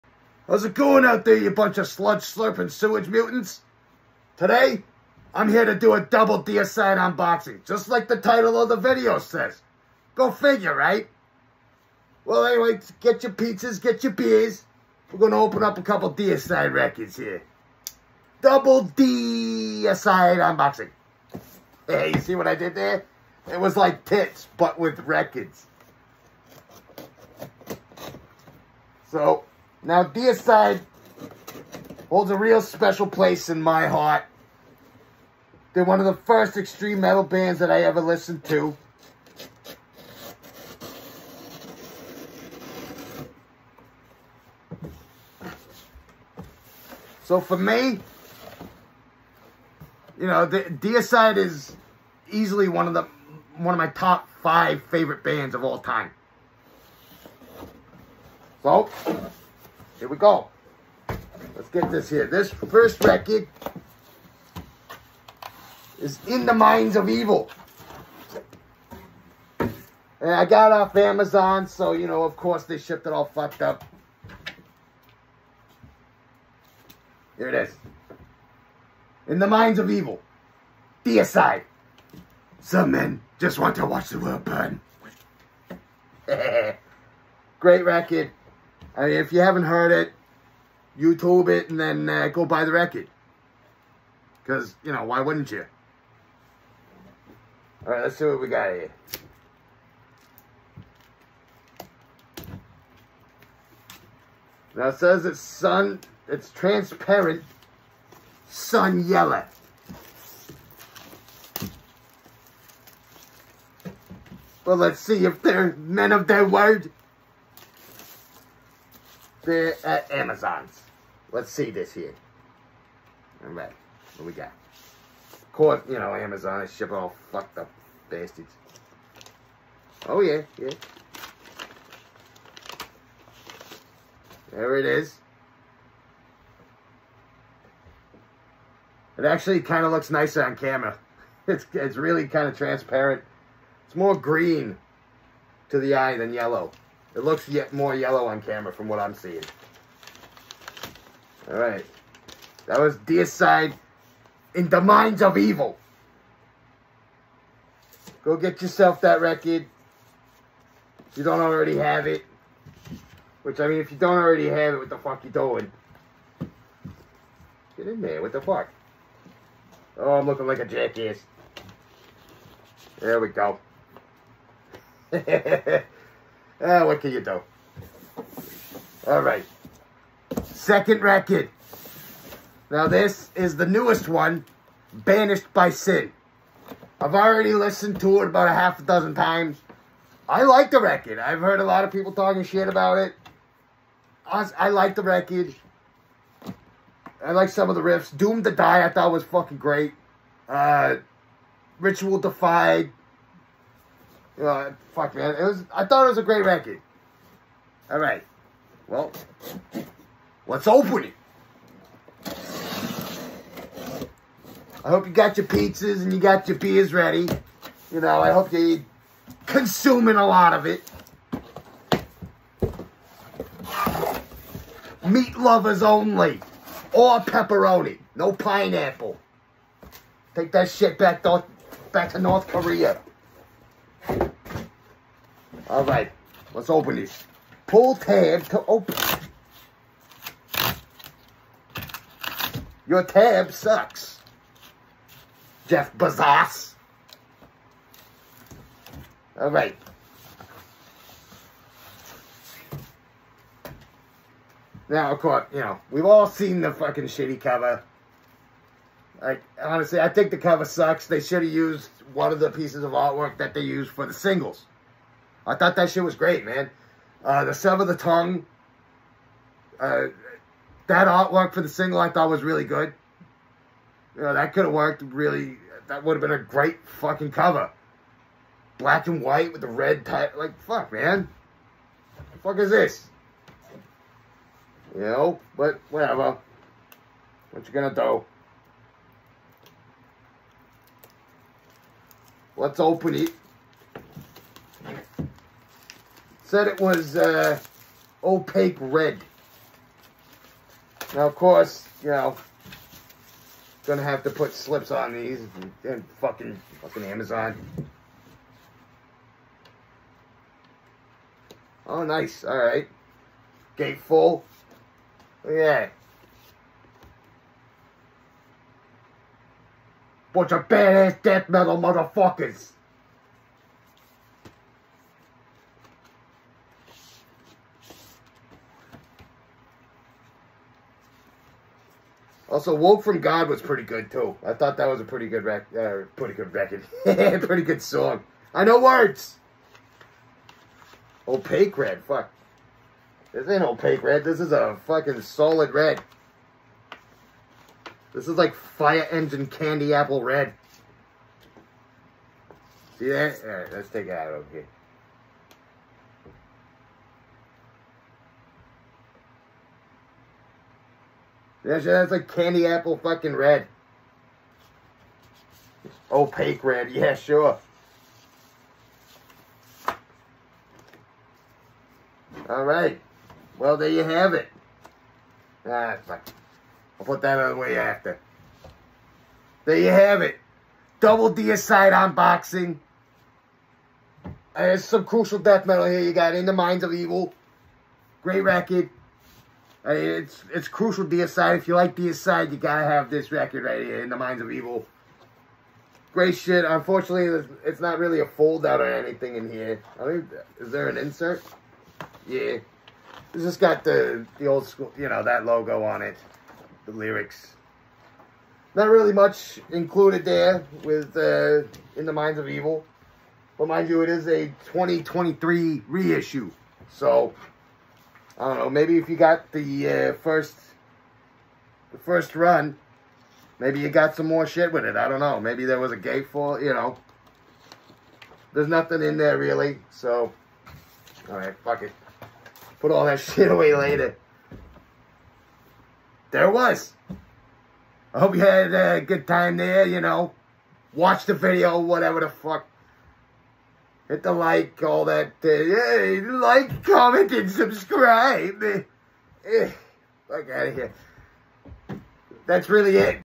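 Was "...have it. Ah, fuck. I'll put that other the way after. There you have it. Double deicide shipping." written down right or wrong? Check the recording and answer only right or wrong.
wrong.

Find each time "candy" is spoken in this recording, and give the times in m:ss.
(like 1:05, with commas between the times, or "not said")
5:49, 6:02.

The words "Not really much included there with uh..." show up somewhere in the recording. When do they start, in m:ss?
6:48.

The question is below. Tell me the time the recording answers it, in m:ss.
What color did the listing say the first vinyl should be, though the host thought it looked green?
1:46.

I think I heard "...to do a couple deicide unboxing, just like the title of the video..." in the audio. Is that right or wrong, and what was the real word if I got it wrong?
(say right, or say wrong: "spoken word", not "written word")
wrong: "double", not "couple".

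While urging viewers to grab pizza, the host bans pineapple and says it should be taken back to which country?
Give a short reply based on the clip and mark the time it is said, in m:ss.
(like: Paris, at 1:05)
North Korea, at 3:52.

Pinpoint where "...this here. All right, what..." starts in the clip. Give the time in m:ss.
2:01.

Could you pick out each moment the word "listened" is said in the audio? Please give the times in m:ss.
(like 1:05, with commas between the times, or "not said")
0:38, 3:07.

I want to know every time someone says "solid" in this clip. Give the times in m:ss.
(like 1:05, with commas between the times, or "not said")
5:45.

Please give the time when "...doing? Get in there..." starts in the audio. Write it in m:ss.
2:45.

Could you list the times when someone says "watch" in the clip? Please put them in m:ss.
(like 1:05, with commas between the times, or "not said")
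1:23, 7:20.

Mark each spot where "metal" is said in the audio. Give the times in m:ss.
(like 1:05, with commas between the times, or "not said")
0:37, 5:21, 6:25.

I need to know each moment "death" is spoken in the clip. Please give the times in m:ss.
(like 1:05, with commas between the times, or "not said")
5:21, 6:25.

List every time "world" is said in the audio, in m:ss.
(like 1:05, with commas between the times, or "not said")
1:24.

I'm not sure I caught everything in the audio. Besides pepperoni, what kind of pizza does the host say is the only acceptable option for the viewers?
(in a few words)
Meat lovers.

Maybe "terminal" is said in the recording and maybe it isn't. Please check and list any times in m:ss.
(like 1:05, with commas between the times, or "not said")
not said.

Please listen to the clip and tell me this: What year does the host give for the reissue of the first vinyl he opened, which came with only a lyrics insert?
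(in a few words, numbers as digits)
2023.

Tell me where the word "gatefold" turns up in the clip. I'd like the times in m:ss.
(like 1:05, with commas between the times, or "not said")
5:13, 7:05.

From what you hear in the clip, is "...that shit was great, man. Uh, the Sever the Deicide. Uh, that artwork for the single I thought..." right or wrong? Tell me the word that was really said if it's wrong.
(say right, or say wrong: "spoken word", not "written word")
wrong: "Tongue", not "Deicide".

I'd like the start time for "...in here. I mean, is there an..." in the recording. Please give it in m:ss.
6:39.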